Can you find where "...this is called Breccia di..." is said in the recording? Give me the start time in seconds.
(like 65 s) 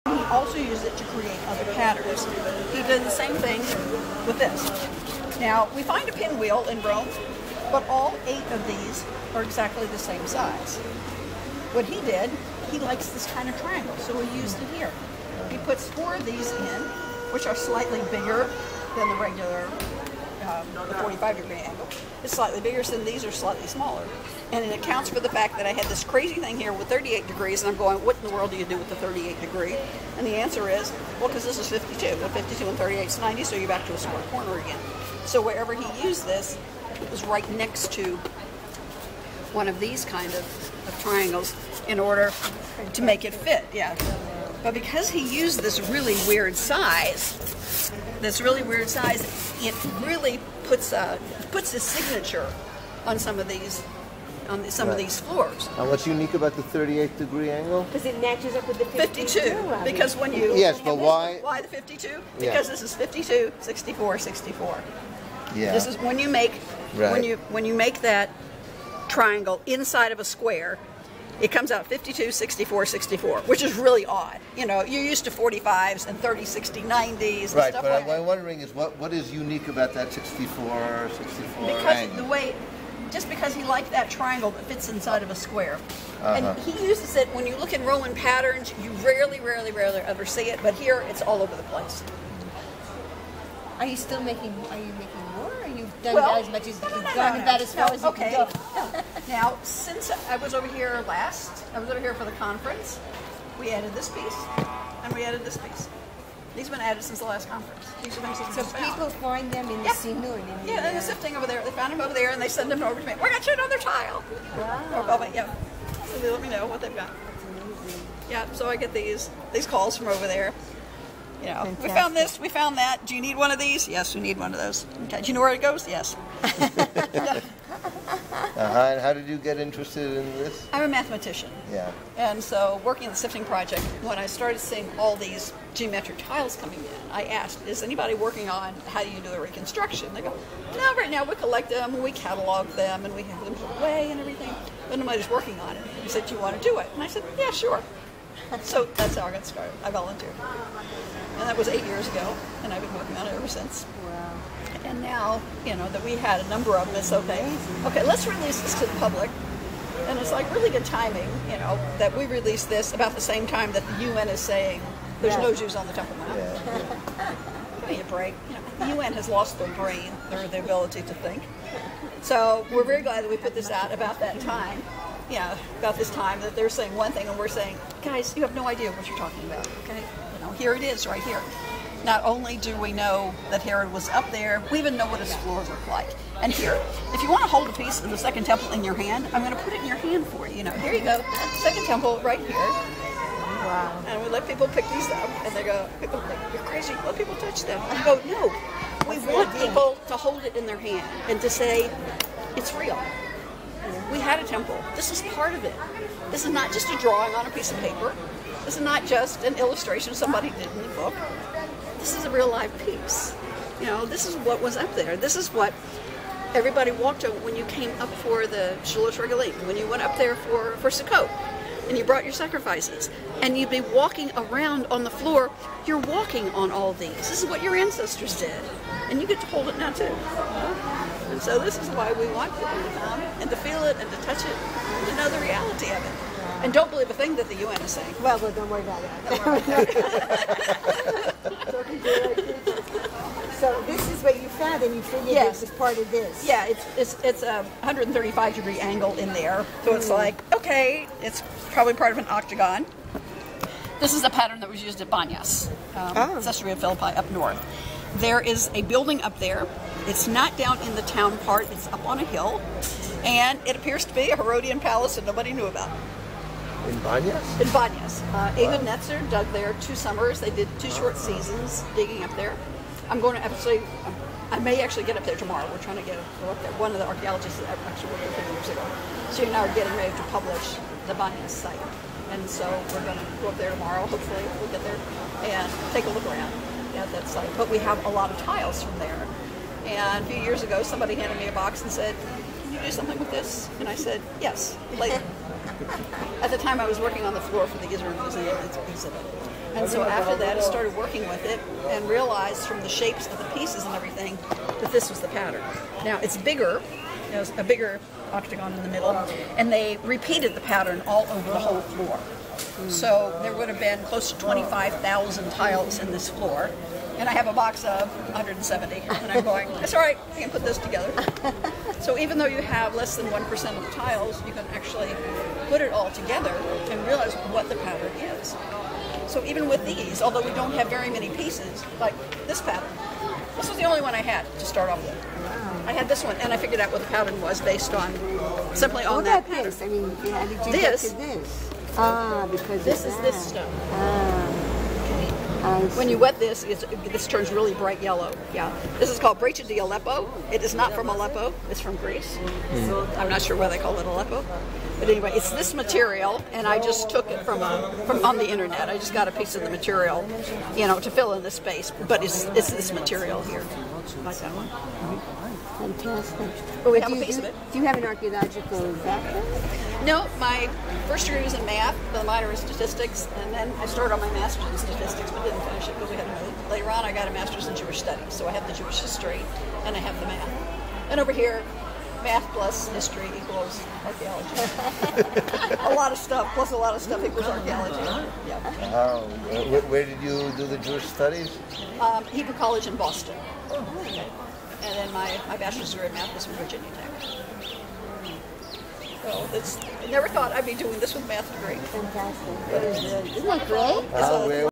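348 s.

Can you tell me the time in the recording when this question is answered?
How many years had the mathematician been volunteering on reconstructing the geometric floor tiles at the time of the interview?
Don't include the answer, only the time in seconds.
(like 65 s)
151 s.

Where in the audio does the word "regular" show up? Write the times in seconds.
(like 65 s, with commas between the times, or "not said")
19 s.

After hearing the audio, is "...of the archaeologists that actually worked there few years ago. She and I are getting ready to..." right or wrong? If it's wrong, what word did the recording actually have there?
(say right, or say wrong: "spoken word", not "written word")
right.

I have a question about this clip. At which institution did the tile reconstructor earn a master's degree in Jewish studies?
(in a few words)
Hebrew College.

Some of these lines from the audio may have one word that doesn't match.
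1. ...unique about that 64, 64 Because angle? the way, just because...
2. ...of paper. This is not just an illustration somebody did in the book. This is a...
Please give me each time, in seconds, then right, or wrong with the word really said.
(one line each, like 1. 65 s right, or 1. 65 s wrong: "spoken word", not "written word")
1. 79 s right
2. 207 s right.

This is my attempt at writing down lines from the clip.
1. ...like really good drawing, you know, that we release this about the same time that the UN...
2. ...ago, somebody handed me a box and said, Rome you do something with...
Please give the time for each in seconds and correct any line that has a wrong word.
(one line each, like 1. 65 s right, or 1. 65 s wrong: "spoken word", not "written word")
1. 160 s wrong: "timing", not "drawing"
2. 290 s wrong: "Can", not "Rome".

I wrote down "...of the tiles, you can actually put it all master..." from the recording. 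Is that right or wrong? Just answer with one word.
wrong.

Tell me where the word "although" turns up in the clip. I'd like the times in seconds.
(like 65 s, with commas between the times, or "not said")
330 s.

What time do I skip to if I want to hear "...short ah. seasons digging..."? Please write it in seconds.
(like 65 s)
270 s.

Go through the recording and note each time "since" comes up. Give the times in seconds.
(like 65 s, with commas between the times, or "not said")
99 s, 107 s, 153 s.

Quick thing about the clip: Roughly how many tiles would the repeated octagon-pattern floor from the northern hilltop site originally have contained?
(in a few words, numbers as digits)
25,000.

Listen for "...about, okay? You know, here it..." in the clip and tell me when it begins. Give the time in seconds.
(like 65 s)
179 s.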